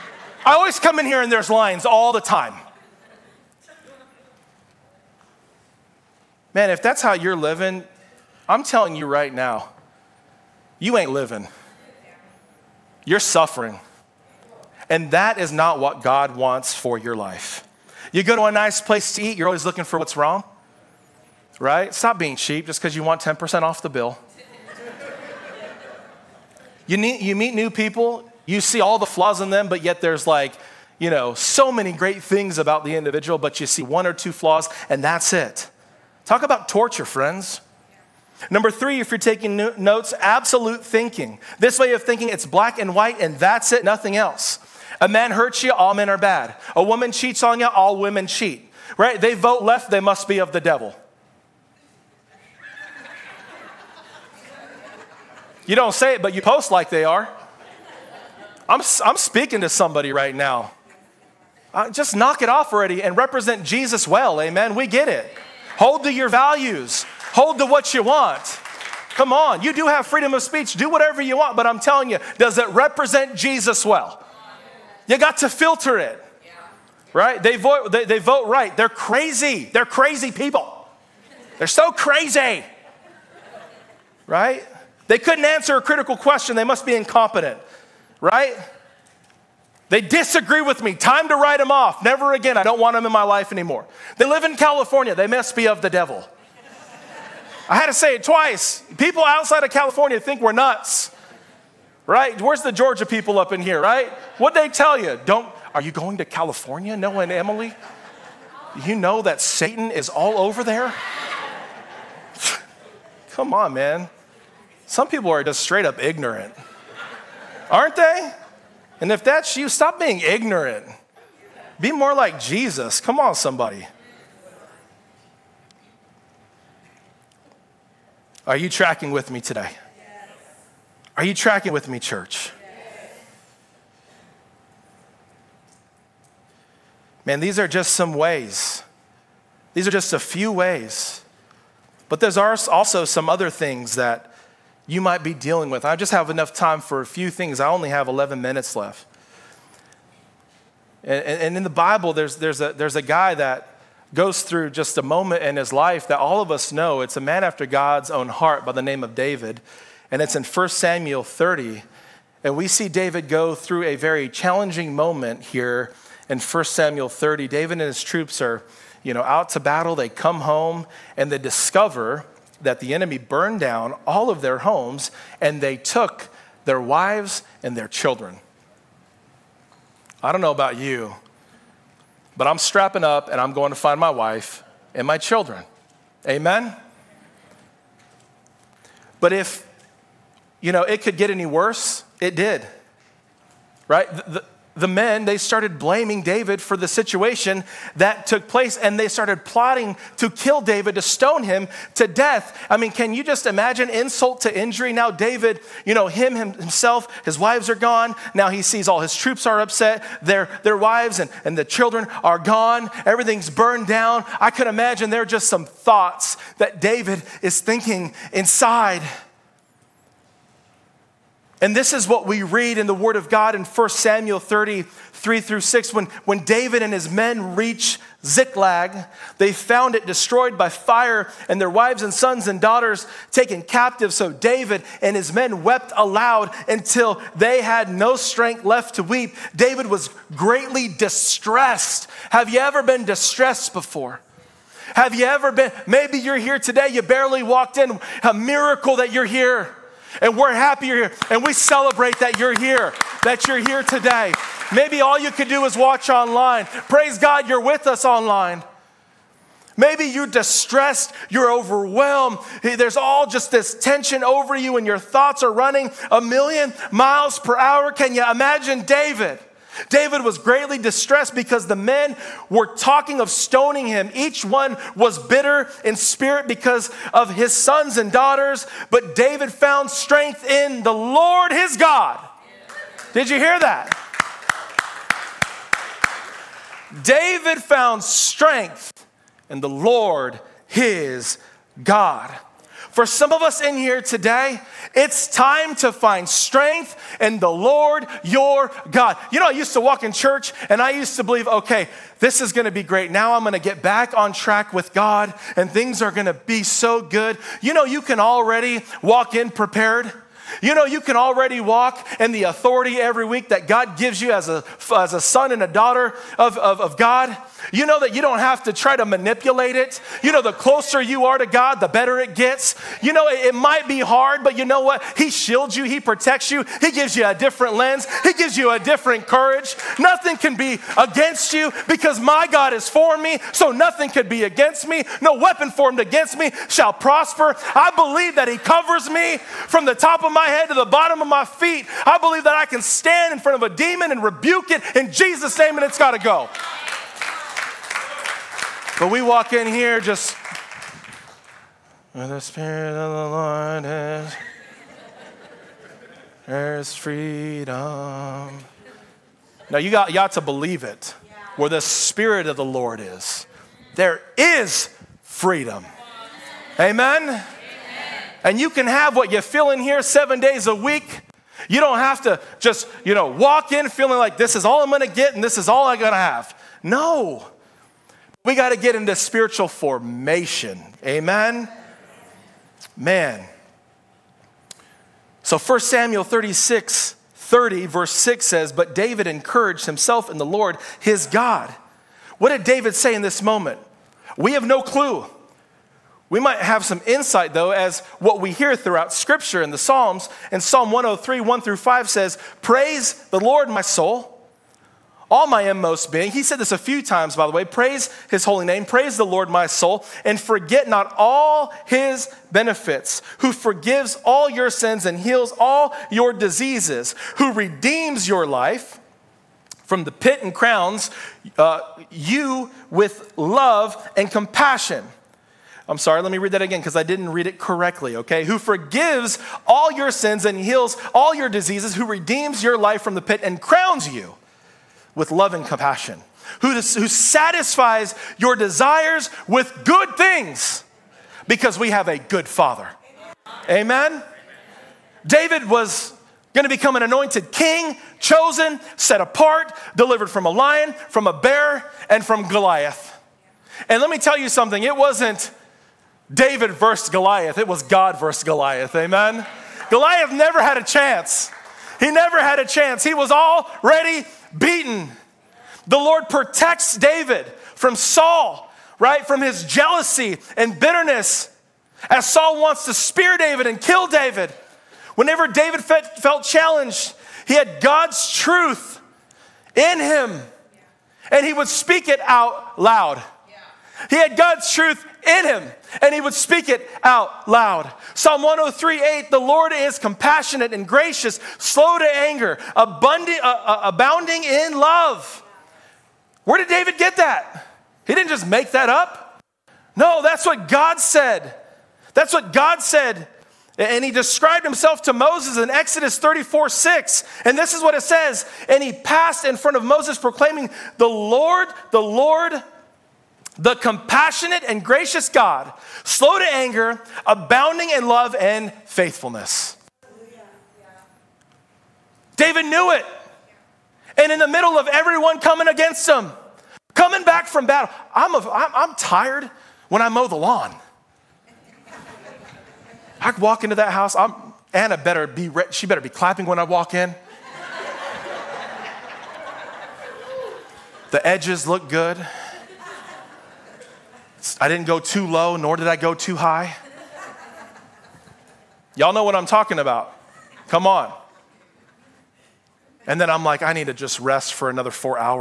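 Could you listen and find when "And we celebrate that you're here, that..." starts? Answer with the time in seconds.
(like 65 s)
251 s.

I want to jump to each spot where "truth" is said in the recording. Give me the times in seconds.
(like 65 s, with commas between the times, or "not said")
478 s, 484 s.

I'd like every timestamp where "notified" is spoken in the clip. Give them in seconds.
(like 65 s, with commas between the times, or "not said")
not said.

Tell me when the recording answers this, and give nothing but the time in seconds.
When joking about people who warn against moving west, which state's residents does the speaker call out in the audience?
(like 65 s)
102 s.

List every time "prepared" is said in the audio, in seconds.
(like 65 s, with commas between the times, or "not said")
309 s.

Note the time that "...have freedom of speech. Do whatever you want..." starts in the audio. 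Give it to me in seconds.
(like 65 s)
69 s.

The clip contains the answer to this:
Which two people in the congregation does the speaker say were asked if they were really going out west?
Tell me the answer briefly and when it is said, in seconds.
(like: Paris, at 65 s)
Noah and Emily, at 106 s.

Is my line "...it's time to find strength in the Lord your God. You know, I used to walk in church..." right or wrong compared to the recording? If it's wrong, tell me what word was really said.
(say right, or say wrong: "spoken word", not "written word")
right.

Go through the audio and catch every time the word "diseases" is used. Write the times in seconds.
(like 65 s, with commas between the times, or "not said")
416 s, 431 s.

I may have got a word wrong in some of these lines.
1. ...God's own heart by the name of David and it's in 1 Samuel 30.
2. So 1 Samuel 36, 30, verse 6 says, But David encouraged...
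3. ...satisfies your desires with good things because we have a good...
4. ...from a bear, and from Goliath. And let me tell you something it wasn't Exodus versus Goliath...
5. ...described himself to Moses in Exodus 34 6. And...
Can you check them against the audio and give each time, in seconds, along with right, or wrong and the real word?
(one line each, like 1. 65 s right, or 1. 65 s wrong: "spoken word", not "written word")
1. 157 s right
2. 385 s right
3. 437 s right
4. 451 s wrong: "David", not "Exodus"
5. 504 s right.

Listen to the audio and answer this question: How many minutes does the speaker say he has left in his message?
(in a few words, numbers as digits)
11.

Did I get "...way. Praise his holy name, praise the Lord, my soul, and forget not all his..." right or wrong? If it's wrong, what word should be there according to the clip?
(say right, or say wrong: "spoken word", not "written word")
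right.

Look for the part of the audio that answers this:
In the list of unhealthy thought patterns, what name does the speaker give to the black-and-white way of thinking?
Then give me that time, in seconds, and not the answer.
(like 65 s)
40 s.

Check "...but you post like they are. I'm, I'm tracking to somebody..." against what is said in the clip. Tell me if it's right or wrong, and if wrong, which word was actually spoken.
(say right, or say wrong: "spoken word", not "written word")
wrong: "speaking", not "tracking".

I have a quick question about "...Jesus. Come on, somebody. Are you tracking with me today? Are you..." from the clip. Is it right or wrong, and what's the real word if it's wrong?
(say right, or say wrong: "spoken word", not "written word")
right.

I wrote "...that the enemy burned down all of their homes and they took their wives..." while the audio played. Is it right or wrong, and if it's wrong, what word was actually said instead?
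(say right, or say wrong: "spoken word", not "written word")
right.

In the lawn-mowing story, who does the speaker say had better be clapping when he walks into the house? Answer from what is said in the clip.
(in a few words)
Anna.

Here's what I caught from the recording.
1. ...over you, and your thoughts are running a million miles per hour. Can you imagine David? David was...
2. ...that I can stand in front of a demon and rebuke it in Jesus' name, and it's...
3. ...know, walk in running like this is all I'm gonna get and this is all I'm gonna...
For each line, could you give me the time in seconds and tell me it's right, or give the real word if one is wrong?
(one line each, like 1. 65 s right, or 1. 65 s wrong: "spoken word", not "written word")
1. 264 s right
2. 342 s right
3. 373 s wrong: "feeling", not "running".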